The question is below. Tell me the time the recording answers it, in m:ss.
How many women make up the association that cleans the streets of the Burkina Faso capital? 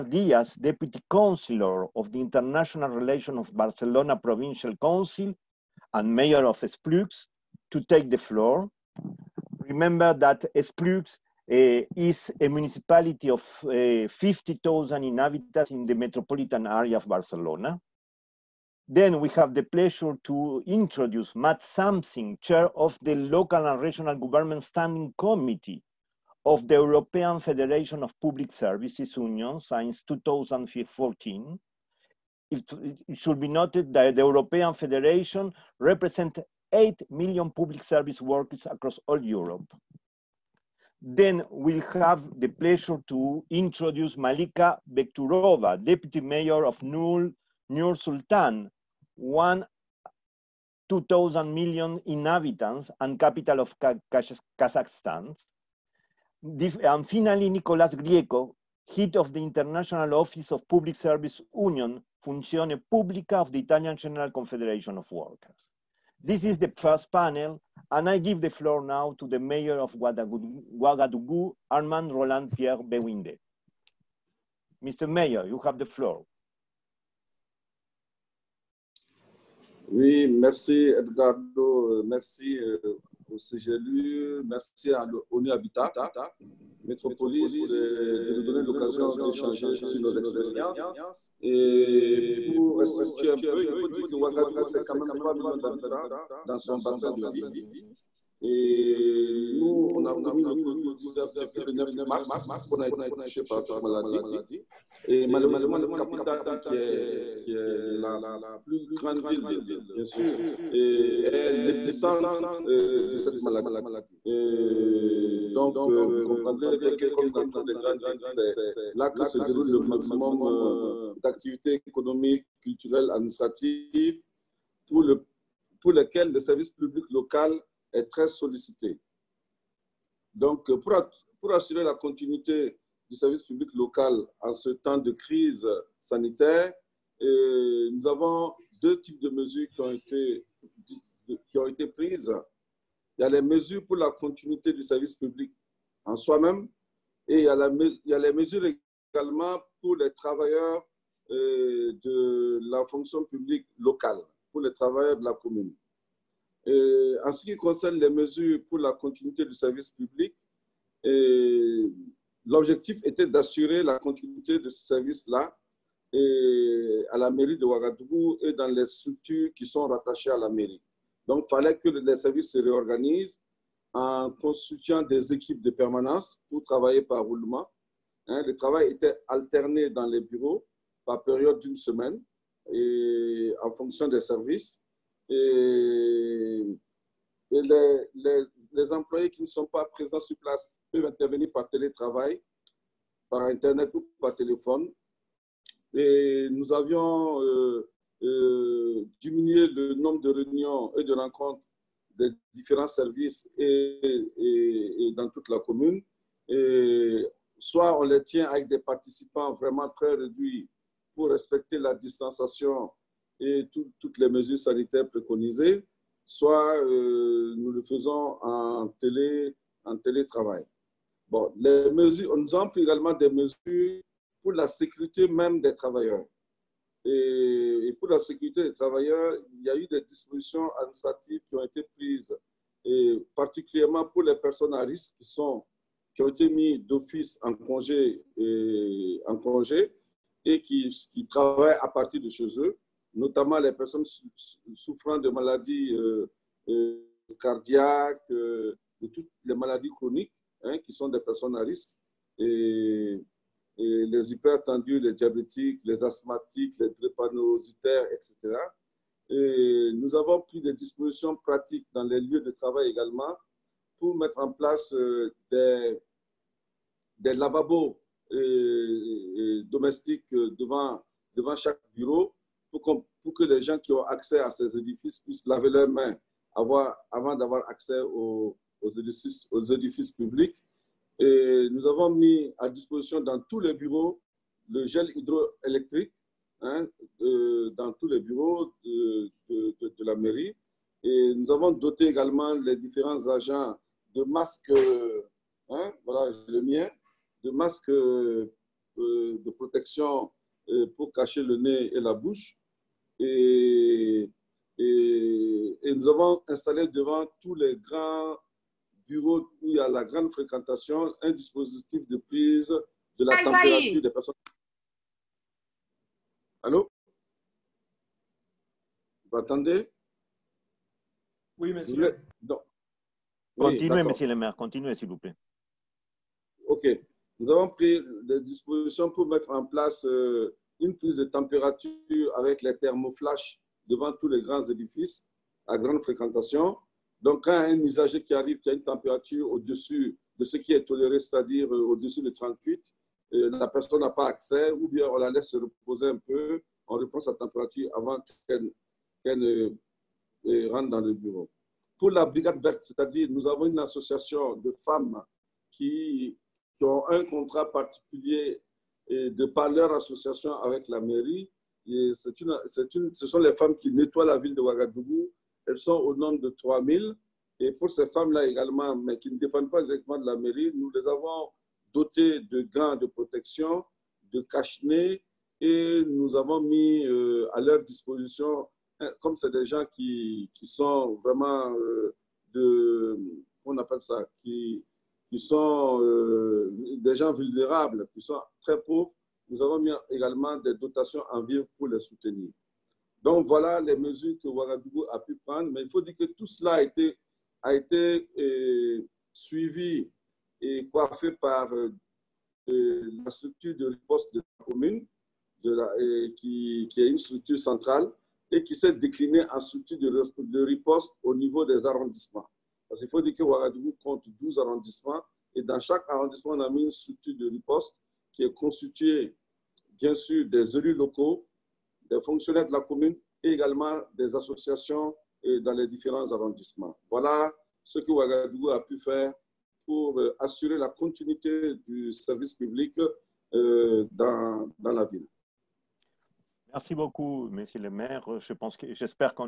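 6:06.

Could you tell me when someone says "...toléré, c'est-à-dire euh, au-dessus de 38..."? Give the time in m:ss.
5:40.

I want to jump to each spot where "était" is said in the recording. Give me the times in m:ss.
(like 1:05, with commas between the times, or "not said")
2:43, 2:58.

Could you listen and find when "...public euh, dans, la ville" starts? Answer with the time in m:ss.
7:12.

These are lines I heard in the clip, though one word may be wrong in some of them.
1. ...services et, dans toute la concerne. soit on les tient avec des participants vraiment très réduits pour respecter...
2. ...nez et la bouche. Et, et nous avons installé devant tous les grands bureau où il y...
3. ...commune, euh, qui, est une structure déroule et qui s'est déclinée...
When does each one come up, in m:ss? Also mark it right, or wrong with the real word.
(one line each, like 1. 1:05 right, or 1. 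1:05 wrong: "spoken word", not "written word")
1. 3:22 wrong: "commune", not "concerne"
2. 5:01 right
3. 6:44 wrong: "centrale", not "déroule".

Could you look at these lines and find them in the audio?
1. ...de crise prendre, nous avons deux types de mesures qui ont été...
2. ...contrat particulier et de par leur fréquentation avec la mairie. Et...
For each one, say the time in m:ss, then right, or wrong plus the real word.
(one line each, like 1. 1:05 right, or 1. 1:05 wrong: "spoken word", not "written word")
1. 2:14 wrong: "sanitaire", not "prendre"
2. 5:57 wrong: "association", not "fréquentation".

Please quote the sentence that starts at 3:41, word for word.
Bon, les mesures, on nous avons également des mesures pour la sécurité même des travailleurs.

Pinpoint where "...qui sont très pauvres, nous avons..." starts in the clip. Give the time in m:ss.
6:28.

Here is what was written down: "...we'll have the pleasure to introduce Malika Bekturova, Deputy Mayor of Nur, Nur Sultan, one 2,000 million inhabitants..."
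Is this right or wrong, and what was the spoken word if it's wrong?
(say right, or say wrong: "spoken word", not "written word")
right.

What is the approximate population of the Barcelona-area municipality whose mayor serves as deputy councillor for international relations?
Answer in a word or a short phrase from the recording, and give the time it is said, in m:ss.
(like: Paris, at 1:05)
50,000, at 0:14.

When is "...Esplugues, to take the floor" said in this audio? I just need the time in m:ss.
0:06.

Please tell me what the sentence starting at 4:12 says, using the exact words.
Et les hypertendus, les diabétiques, les asthmatiques, les trépanositaires, etc.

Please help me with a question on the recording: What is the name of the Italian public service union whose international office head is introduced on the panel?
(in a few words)
Funzione Pubblica.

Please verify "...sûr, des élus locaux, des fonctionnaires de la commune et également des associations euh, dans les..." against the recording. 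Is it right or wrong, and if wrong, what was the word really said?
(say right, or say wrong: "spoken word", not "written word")
right.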